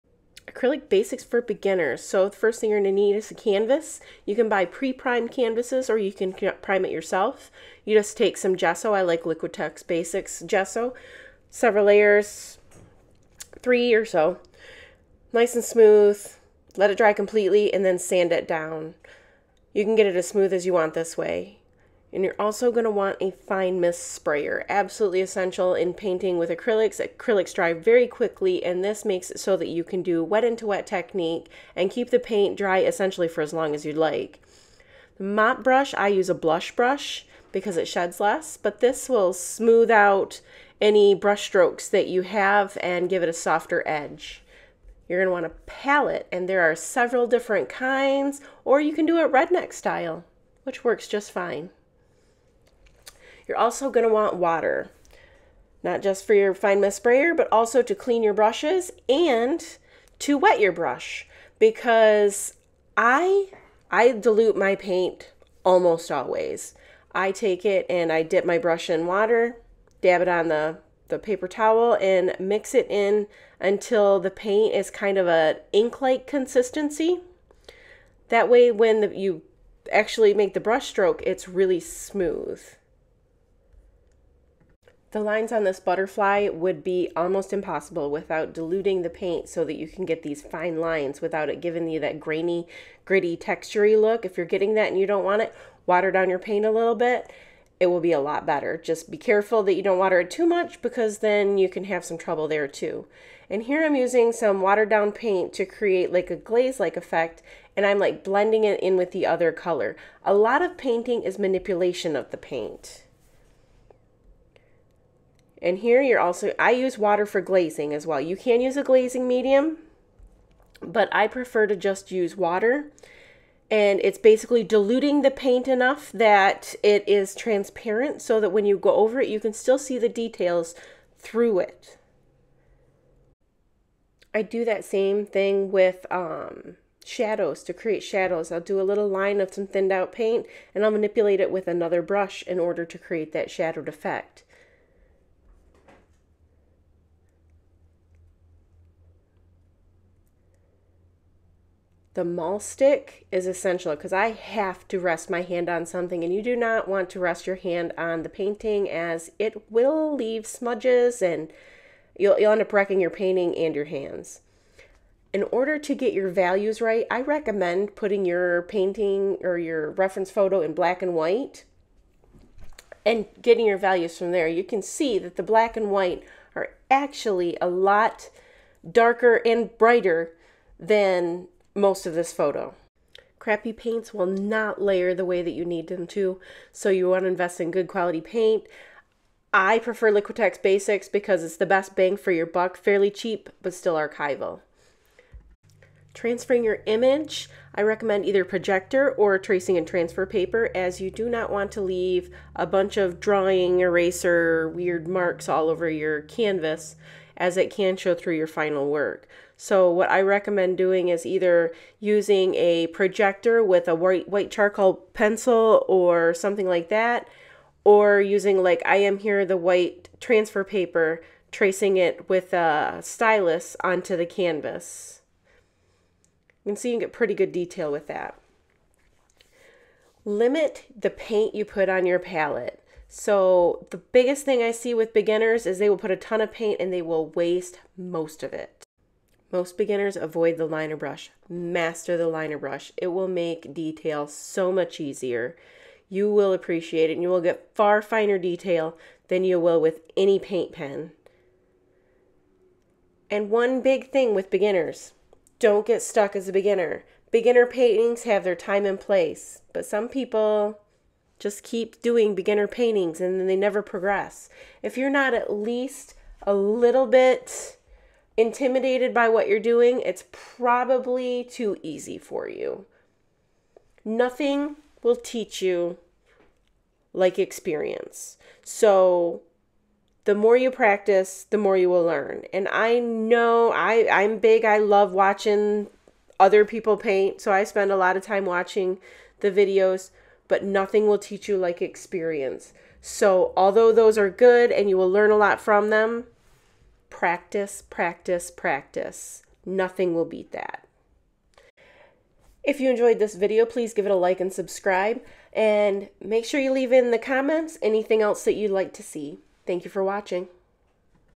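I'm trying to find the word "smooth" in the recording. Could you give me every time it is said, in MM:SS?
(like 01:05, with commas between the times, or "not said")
00:15, 00:20, 00:39, 01:21.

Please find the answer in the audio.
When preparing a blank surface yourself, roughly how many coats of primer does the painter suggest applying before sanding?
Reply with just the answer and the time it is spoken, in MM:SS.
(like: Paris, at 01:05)
3, at 00:13.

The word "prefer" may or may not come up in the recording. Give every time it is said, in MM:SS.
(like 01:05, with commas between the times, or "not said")
02:01, 03:09.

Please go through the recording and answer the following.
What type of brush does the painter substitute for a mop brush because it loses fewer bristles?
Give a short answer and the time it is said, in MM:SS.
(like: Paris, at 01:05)
Blush brush, at 00:36.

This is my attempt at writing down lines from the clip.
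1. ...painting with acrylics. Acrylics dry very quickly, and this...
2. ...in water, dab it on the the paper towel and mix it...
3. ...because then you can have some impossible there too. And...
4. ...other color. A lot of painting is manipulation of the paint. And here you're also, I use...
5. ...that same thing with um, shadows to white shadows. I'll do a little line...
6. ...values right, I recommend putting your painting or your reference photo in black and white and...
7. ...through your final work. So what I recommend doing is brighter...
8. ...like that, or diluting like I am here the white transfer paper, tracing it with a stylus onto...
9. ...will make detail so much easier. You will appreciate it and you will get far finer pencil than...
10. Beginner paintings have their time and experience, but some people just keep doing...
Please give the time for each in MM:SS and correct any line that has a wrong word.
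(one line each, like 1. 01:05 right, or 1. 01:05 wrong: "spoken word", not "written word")
1. 00:25 right
2. 01:08 right
3. 01:40 wrong: "trouble", not "impossible"
4. 01:49 right
5. 02:14 wrong: "create", not "white"
6. 02:46 right
7. 03:28 wrong: "either", not "brighter"
8. 03:36 wrong: "using", not "diluting"
9. 04:03 wrong: "detail", not "pencil"
10. 04:17 wrong: "place", not "experience".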